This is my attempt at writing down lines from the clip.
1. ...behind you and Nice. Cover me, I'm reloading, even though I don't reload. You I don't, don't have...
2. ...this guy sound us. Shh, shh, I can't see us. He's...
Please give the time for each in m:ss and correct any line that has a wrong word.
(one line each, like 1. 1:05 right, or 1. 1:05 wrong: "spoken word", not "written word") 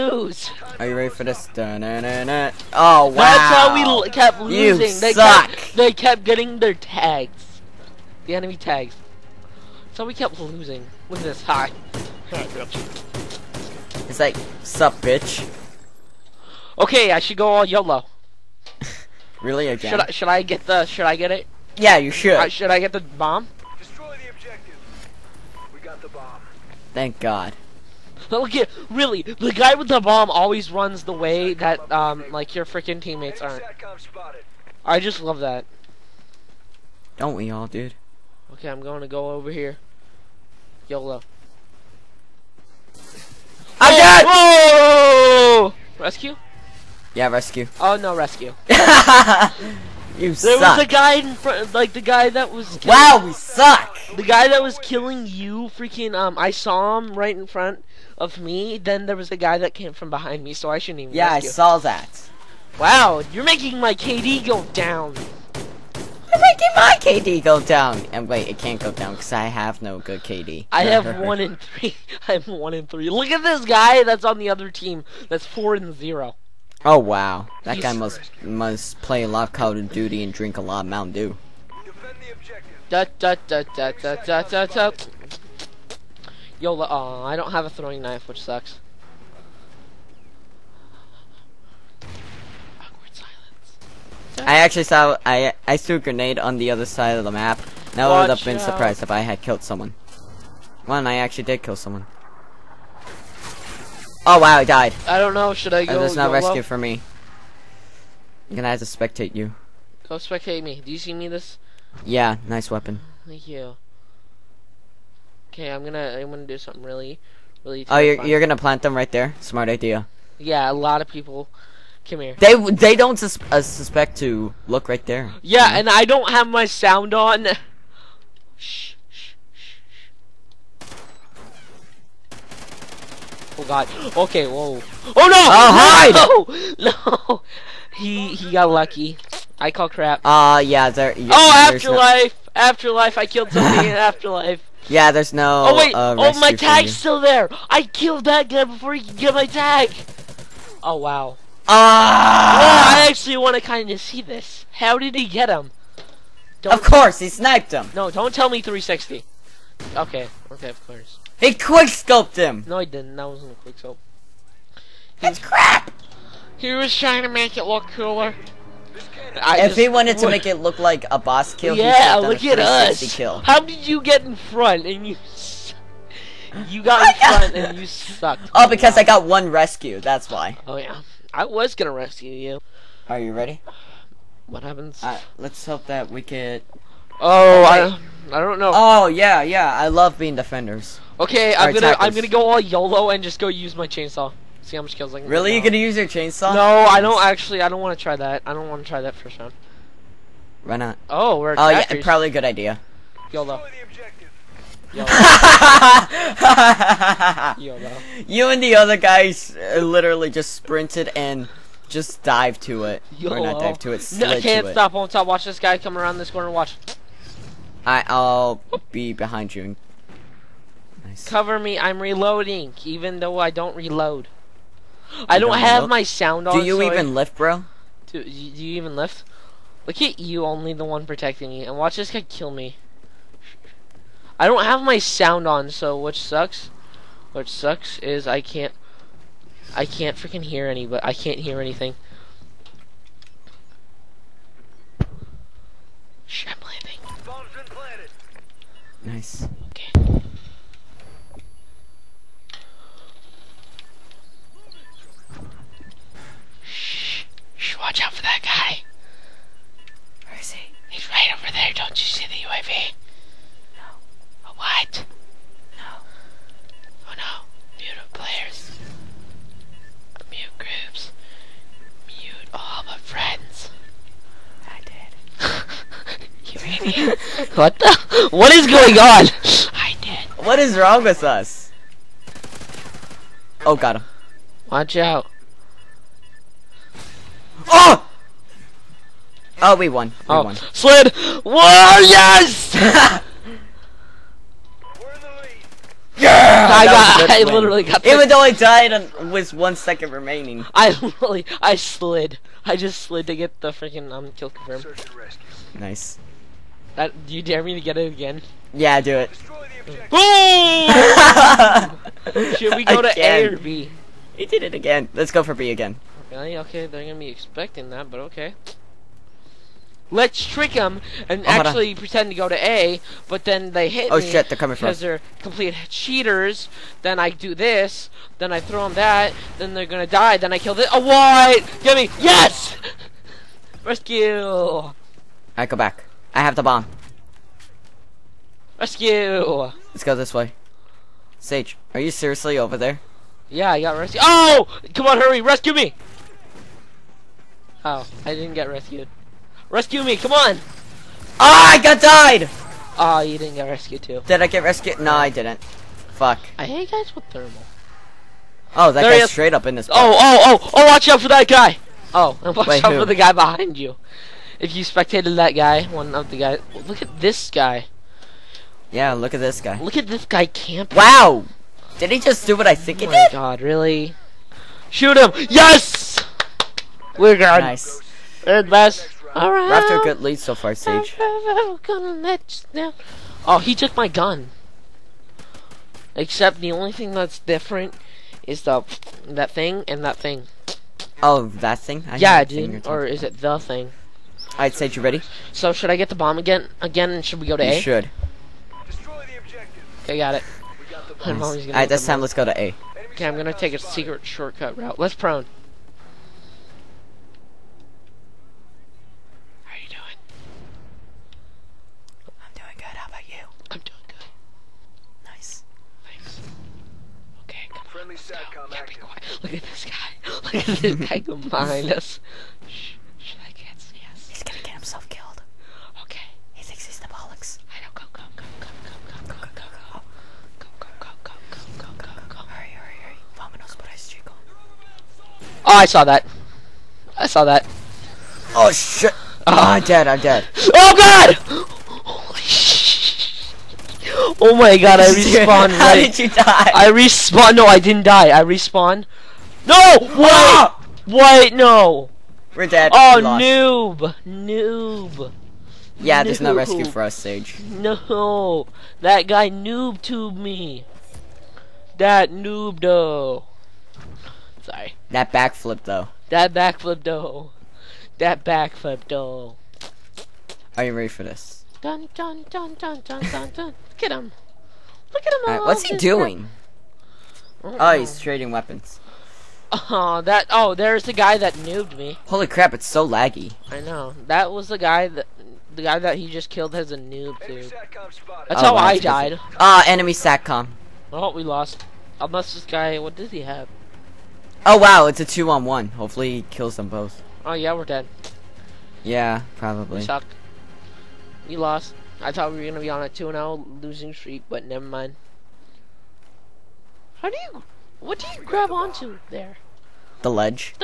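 1. 3:39 right
2. 7:00 wrong: "behind", not "sound".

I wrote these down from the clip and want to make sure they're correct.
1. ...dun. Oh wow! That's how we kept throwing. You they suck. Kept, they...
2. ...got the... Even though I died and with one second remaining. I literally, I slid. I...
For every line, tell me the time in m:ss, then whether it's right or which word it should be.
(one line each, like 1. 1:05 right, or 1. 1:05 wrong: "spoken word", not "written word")
1. 0:02 wrong: "losing", not "throwing"
2. 4:57 right.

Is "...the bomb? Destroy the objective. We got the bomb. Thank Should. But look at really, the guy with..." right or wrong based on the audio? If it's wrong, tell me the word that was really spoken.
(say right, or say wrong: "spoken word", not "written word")
wrong: "God", not "Should".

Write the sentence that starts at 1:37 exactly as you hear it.
Now I would have been surprised if I had killed someone.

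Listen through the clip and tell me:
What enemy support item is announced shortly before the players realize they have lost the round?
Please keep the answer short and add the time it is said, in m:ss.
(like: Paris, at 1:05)
enemy satcom, at 8:09.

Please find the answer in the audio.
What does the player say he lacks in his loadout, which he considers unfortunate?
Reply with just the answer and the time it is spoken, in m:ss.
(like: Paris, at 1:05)
throwing knife, at 1:27.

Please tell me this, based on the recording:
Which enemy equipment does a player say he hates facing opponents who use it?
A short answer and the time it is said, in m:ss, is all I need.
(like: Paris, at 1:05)
thermal, at 5:57.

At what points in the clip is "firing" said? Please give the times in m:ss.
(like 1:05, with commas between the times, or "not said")
not said.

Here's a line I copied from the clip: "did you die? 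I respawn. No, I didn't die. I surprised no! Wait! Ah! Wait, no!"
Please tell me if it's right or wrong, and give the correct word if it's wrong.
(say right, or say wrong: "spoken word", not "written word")
wrong: "respawned", not "surprised".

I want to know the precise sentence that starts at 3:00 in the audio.
Oh yeah, I was gonna rescue you.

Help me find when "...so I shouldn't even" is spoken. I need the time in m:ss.
1:00.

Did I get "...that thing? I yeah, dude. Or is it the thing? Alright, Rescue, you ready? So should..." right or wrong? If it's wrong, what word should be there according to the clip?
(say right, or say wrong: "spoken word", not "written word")
wrong: "Sage", not "Rescue".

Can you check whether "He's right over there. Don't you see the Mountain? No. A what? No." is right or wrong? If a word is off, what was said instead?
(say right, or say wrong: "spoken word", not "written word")
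wrong: "UAV", not "Mountain".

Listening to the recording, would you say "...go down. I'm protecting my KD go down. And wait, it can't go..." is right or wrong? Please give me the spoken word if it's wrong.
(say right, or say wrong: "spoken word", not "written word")
wrong: "making", not "protecting".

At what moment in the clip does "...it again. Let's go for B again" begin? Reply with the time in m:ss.
5:14.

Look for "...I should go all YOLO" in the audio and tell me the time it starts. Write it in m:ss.
0:17.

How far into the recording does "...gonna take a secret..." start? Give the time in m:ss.
6:43.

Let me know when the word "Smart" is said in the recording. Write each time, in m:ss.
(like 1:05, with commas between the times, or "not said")
1:59.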